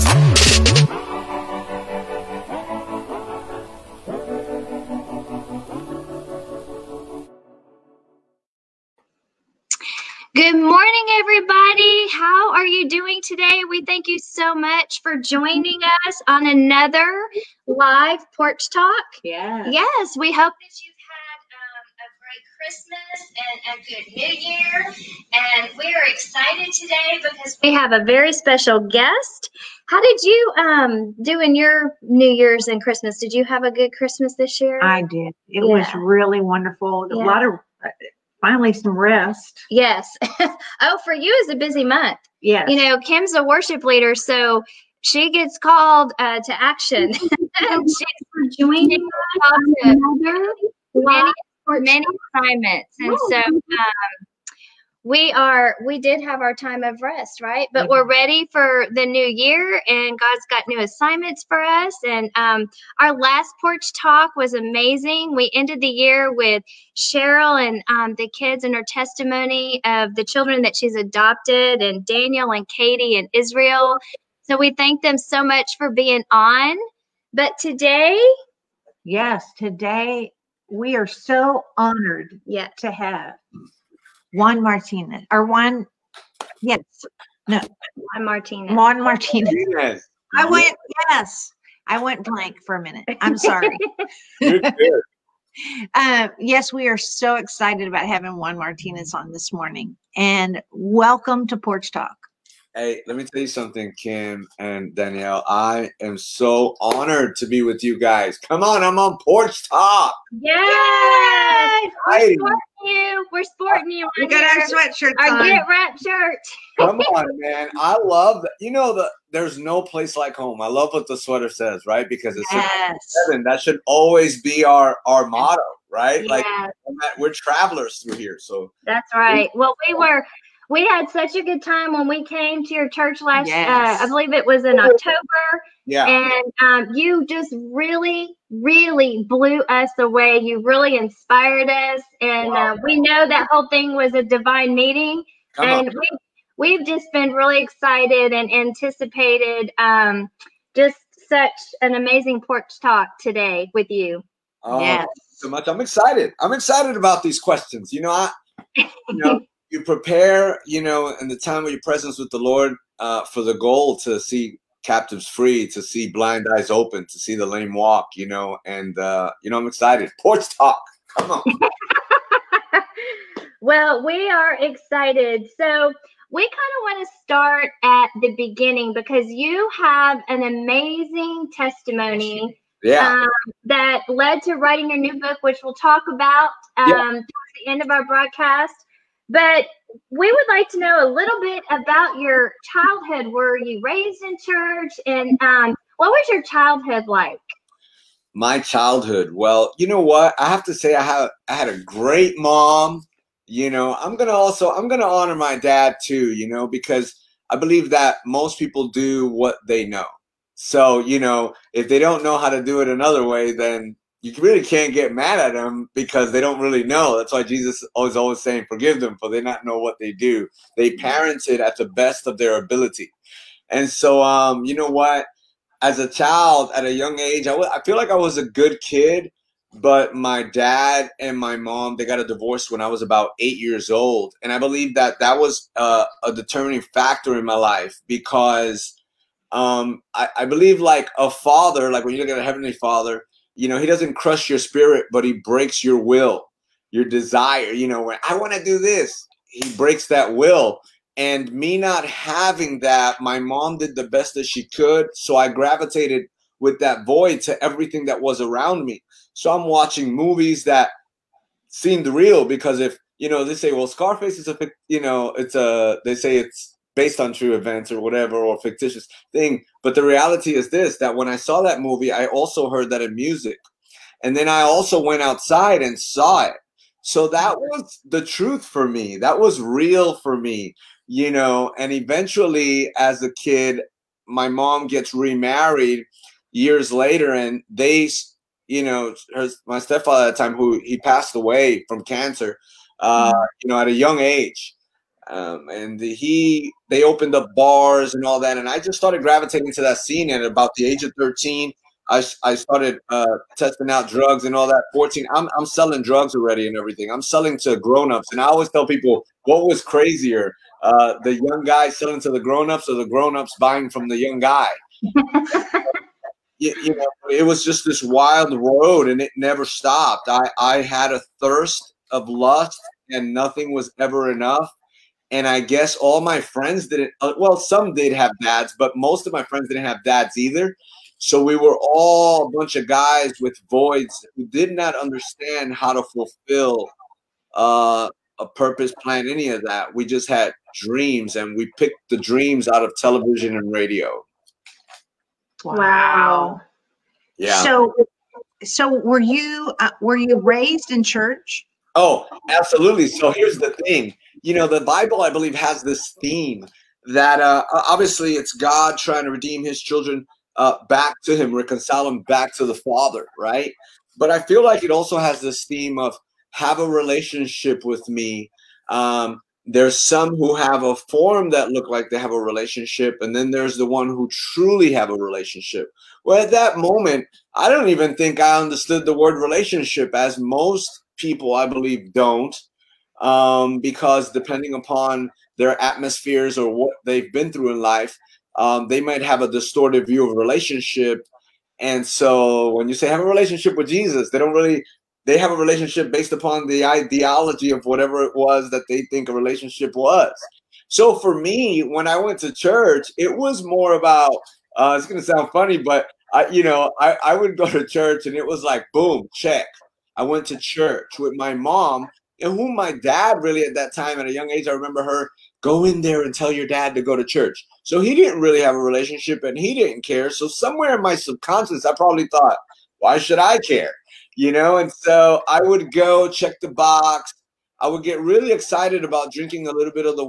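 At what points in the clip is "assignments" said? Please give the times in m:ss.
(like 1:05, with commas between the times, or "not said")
0:52, 1:00.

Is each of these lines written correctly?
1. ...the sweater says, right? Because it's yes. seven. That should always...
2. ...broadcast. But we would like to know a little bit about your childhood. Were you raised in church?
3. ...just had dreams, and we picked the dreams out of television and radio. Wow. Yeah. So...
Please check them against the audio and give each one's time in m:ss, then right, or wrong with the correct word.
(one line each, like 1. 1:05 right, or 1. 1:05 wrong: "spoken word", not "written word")
1. 2:01 right
2. 3:08 right
3. 5:40 right.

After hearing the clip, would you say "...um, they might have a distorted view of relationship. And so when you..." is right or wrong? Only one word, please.
right.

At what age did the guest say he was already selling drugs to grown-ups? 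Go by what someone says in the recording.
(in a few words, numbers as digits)
14.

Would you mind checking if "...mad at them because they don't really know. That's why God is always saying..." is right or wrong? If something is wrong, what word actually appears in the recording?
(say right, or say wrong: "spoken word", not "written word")
wrong: "Jesus", not "God".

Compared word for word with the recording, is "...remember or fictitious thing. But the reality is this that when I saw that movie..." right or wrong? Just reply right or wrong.
wrong.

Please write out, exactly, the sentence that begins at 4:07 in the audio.
You know, when I want to do this, he breaks that will.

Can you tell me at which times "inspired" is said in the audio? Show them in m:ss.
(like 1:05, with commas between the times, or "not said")
2:20.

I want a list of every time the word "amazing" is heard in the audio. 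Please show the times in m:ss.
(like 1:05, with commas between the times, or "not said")
1:04, 2:31, 3:00.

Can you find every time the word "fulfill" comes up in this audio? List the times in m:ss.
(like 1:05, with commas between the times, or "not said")
5:36.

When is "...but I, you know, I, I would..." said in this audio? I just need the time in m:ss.
6:45.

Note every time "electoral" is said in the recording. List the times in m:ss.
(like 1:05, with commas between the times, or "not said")
not said.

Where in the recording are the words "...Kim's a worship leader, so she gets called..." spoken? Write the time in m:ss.
0:42.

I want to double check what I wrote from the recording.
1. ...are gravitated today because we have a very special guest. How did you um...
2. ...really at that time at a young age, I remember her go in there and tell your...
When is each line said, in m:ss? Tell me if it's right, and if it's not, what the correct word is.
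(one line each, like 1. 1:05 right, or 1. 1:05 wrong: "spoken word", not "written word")
1. 0:25 wrong: "excited", not "gravitated"
2. 6:53 right.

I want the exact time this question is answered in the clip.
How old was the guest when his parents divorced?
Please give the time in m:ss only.
3:53.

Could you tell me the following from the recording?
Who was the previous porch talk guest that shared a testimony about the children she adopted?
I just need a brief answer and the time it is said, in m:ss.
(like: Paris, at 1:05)
Cheryl, at 1:06.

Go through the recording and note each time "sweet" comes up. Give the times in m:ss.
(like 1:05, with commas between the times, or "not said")
not said.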